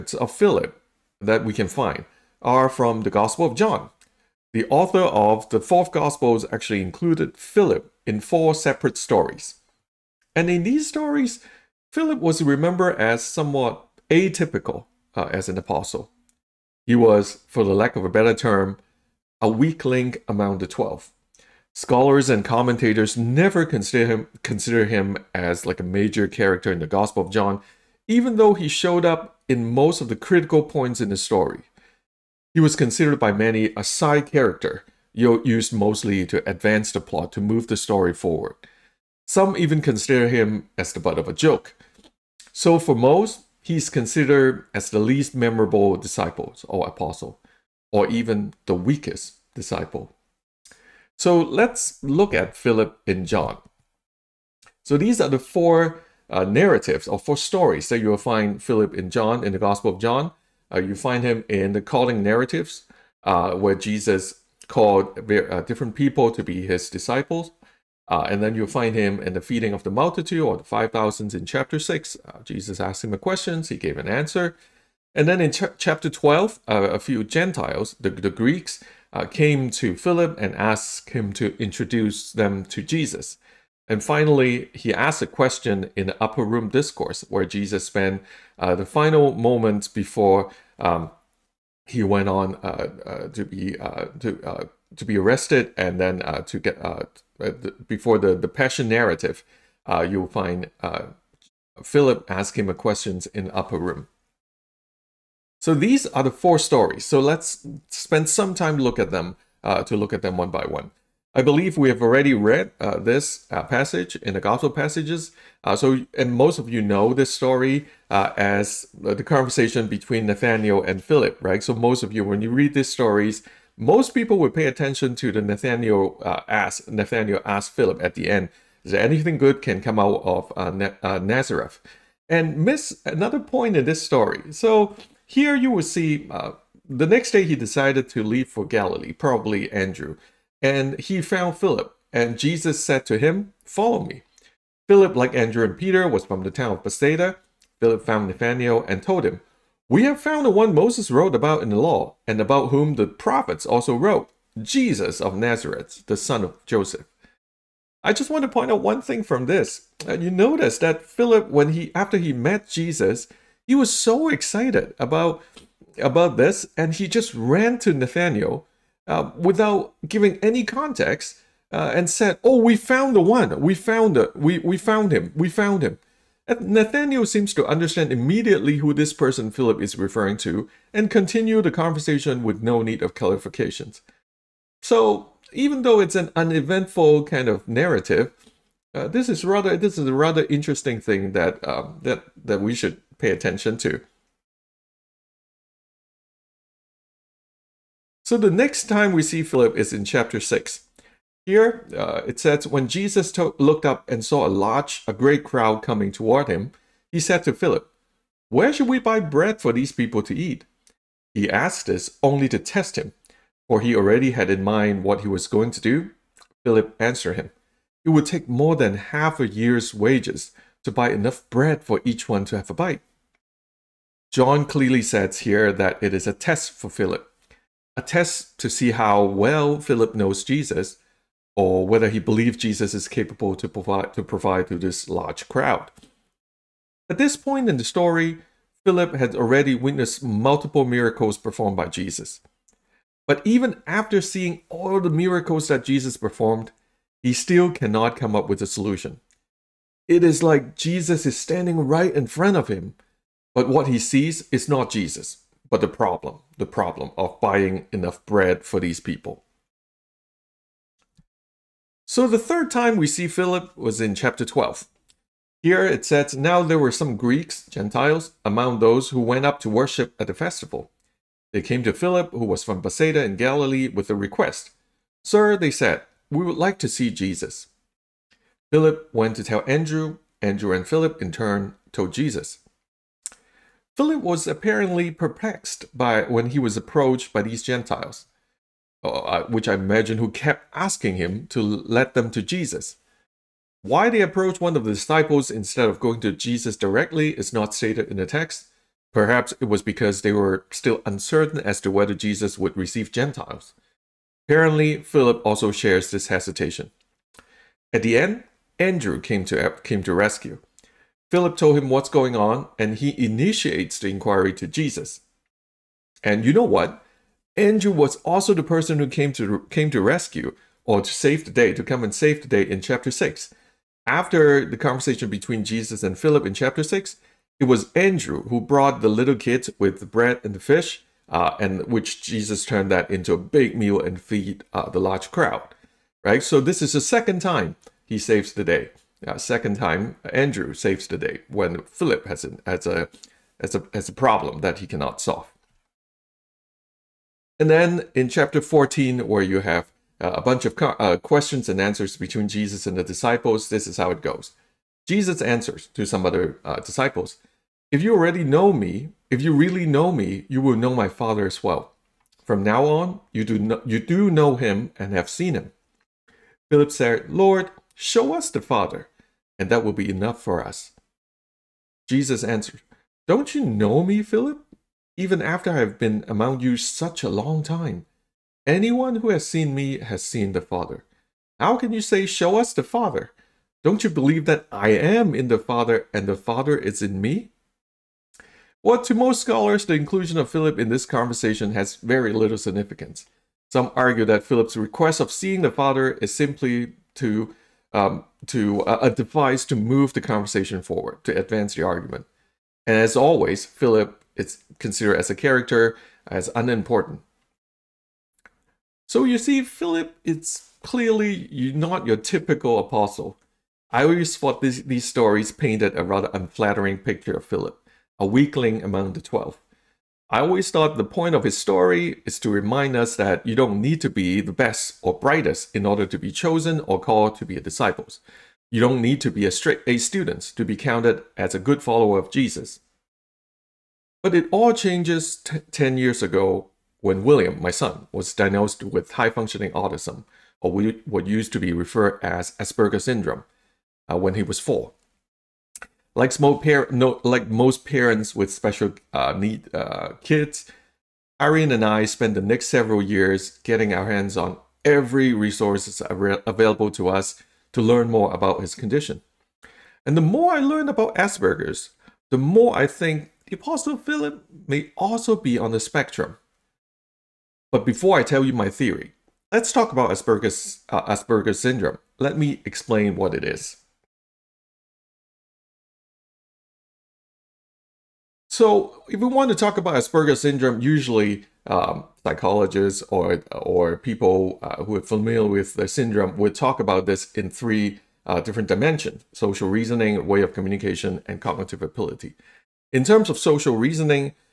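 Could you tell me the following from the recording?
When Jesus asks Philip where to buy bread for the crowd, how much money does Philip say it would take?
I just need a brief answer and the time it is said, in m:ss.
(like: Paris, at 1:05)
More than half a year's wages, at 3:38.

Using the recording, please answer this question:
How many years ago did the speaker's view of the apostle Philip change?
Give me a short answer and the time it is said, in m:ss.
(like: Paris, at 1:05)
10, at 7:15.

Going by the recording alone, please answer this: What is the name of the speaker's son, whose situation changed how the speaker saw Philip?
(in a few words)
William.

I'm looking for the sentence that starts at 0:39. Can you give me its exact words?
Some even consider him as the butt of a joke.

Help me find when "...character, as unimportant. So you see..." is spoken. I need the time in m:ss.
6:45.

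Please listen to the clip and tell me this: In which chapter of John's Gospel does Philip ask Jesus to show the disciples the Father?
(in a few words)
Chapter 14.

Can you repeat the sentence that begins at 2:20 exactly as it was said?
And he found Philip, and Jesus said to him, Follow me.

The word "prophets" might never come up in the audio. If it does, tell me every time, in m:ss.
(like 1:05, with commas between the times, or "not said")
2:33.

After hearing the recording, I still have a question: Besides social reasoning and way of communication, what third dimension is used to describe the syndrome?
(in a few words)
Cognitive ability.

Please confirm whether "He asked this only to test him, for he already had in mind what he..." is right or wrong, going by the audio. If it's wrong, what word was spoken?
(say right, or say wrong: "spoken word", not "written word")
right.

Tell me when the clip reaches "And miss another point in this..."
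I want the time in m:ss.
2:12.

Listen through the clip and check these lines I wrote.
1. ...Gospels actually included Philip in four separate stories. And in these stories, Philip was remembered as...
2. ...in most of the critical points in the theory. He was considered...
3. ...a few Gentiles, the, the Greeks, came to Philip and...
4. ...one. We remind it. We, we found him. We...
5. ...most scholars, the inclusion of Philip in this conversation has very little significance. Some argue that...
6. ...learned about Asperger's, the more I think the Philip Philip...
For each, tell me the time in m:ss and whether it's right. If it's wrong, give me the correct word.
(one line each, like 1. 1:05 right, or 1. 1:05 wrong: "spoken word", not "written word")
1. 0:05 right
2. 0:29 wrong: "story", not "theory"
3. 1:16 right
4. 2:53 wrong: "found", not "remind"
5. 6:29 right
6. 7:40 wrong: "Apostle", not "Philip".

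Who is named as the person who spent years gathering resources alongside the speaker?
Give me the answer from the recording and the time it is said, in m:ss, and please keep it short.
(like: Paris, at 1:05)
Irene, at 7:31.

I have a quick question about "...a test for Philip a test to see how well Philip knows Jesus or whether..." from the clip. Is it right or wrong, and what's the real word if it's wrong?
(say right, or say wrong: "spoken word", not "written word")
right.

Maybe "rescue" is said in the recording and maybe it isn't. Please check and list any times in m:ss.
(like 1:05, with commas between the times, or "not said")
5:10, 5:19.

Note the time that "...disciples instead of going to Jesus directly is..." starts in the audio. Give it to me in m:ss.
4:54.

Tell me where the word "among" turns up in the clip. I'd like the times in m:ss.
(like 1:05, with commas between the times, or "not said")
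0:20, 4:28, 6:16, 6:58.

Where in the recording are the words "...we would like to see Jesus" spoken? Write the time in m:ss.
4:36.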